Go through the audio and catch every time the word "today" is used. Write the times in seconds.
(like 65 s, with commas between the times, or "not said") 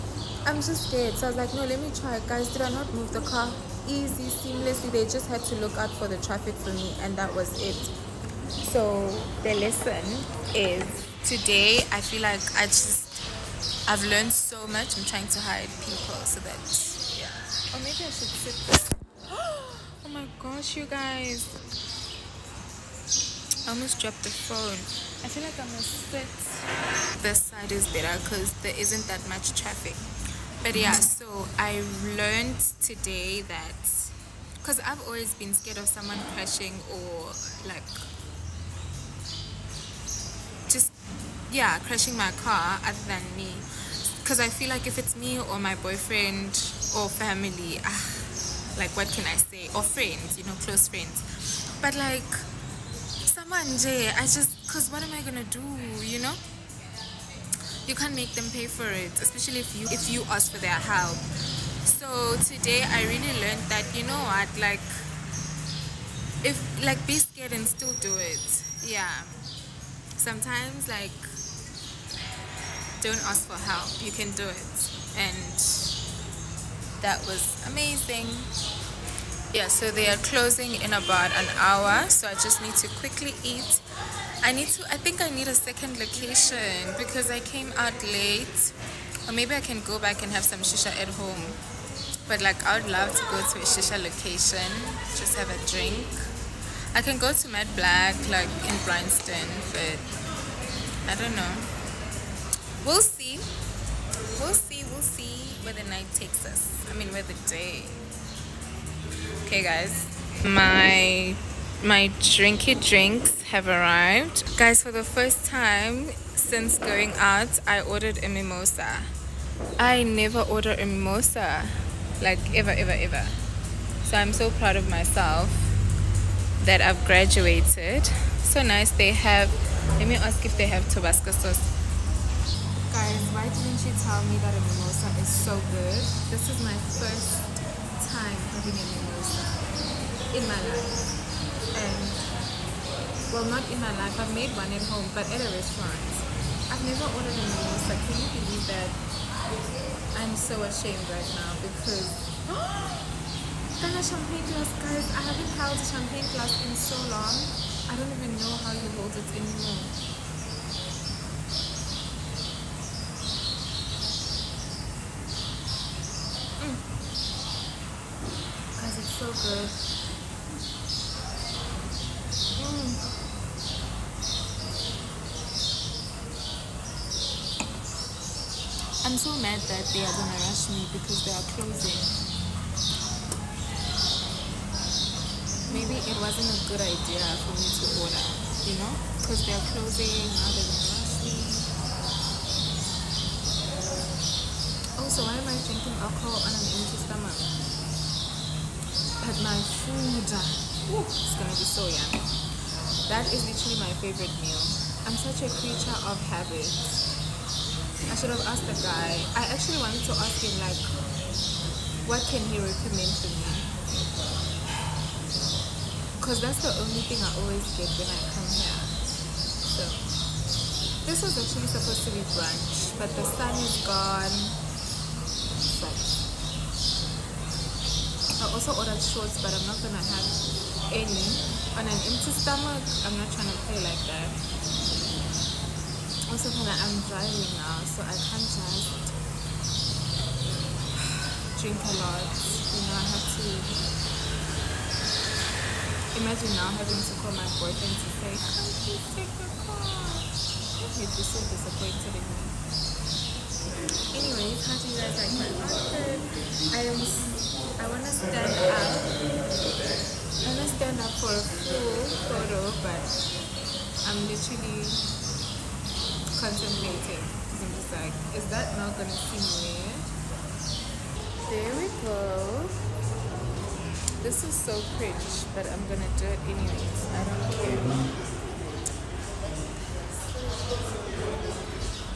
11 s, 32 s, 62 s.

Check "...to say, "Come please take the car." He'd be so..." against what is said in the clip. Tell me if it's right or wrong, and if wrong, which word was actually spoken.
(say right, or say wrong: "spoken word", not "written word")
right.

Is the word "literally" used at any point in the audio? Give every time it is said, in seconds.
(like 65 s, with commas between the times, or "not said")
203 s, 264 s.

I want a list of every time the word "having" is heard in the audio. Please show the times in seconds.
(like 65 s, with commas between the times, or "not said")
138 s, 246 s.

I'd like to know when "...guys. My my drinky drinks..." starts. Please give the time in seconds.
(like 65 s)
109 s.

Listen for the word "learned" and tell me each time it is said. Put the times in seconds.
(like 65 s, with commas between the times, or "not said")
14 s, 32 s, 63 s.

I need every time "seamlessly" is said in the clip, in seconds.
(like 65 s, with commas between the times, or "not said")
4 s.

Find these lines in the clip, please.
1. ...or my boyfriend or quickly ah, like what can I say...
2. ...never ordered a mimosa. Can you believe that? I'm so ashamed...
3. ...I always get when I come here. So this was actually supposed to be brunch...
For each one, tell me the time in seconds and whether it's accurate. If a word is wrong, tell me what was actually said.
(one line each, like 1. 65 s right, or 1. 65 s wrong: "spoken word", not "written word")
1. 45 s wrong: "family", not "quickly"
2. 146 s right
3. 217 s right.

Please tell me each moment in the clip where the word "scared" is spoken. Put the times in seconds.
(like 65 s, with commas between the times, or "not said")
0 s, 35 s, 67 s.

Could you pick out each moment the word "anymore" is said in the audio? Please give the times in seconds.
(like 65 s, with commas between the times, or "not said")
159 s.